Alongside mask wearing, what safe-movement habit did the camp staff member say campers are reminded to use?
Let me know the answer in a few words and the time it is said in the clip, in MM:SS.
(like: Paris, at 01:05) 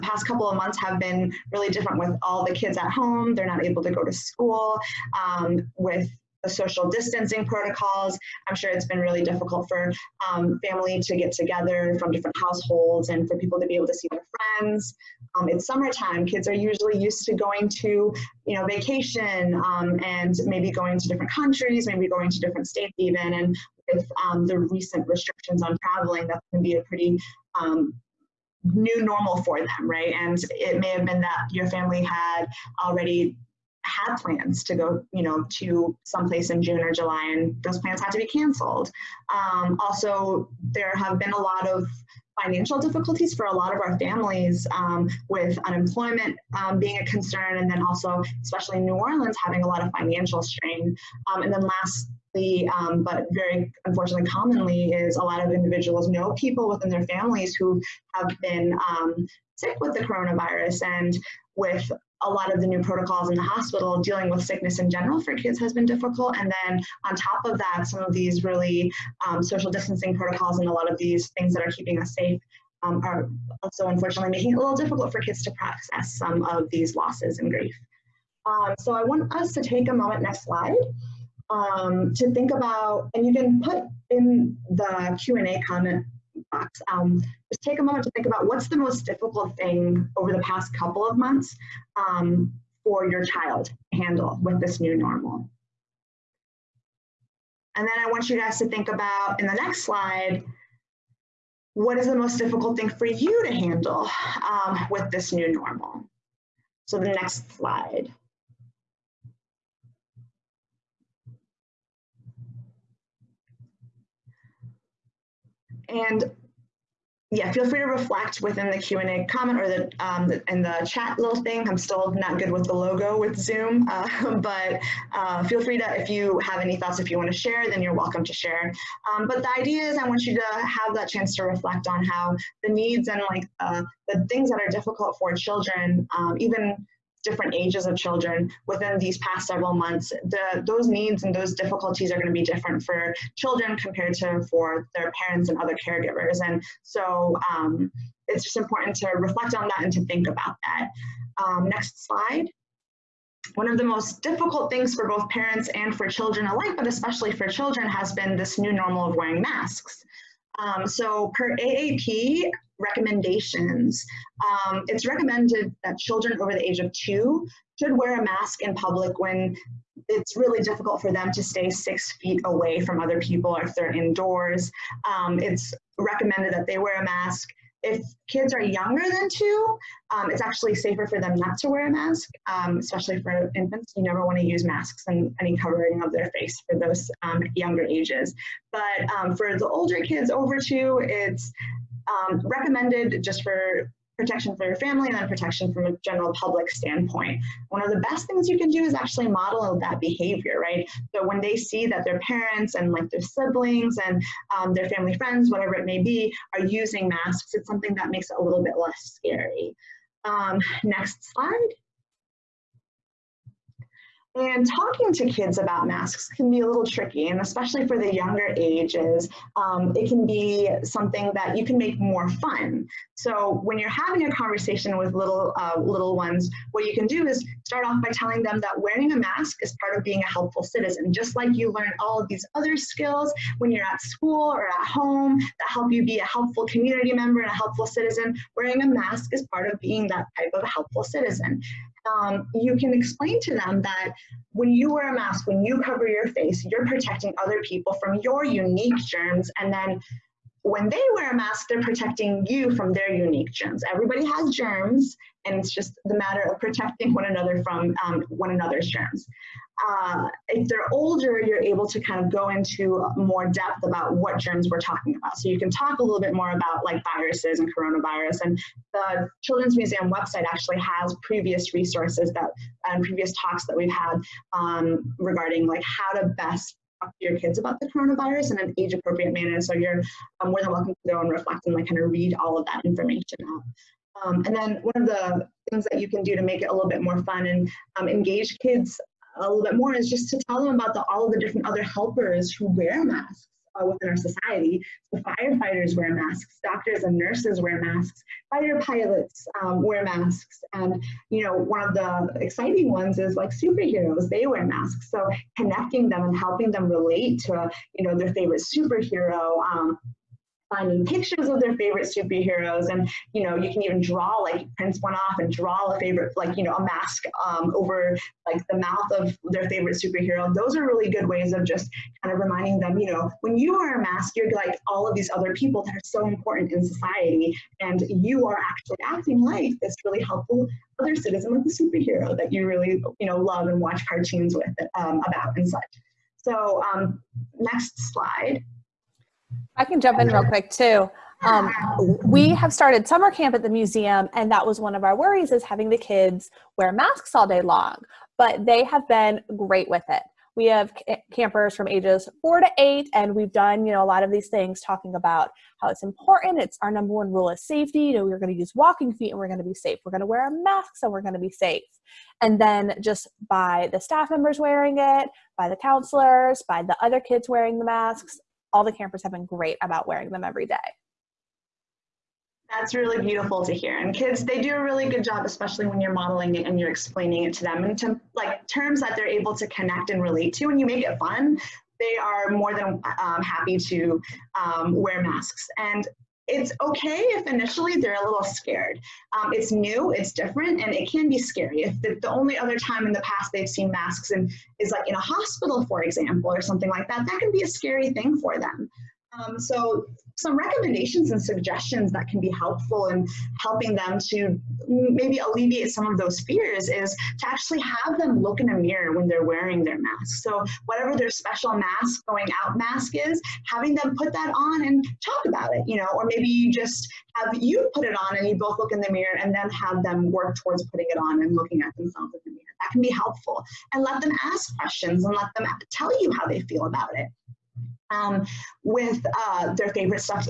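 walking feet, at 05:58.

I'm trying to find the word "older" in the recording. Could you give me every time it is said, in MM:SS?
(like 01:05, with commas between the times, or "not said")
03:09, 04:20.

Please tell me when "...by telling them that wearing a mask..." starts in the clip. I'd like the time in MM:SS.
03:48.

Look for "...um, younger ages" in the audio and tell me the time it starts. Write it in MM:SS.
03:07.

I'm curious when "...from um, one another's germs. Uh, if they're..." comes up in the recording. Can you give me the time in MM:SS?
04:17.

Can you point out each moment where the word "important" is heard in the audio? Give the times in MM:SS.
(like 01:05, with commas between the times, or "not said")
02:28, 05:26, 05:56.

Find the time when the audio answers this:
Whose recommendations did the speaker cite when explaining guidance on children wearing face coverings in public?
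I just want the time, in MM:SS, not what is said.
02:41.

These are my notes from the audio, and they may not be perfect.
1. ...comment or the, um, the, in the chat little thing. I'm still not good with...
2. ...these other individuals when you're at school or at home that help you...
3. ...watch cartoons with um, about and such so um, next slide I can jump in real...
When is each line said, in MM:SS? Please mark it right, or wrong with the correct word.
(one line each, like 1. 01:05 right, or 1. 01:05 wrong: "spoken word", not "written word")
1. 01:59 right
2. 03:52 wrong: "skills", not "individuals"
3. 05:33 right.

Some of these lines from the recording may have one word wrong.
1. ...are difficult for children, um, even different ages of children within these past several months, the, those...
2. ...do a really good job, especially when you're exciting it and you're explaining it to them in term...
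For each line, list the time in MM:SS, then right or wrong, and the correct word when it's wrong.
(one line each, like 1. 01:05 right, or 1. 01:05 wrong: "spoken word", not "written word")
1. 02:14 right
2. 06:14 wrong: "modeling", not "exciting".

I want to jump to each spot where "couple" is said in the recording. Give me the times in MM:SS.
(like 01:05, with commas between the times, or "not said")
00:00, 01:30.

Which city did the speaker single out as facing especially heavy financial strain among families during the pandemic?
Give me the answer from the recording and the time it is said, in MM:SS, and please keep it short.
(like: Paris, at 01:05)
New Orleans, at 00:48.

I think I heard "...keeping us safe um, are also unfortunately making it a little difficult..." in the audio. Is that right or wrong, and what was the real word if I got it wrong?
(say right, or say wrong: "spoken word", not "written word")
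right.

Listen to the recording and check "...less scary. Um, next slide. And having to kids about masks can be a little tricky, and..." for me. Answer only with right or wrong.
wrong.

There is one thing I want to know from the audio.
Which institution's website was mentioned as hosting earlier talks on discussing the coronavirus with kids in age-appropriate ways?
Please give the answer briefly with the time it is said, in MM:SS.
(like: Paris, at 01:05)
Children's Museum, at 04:29.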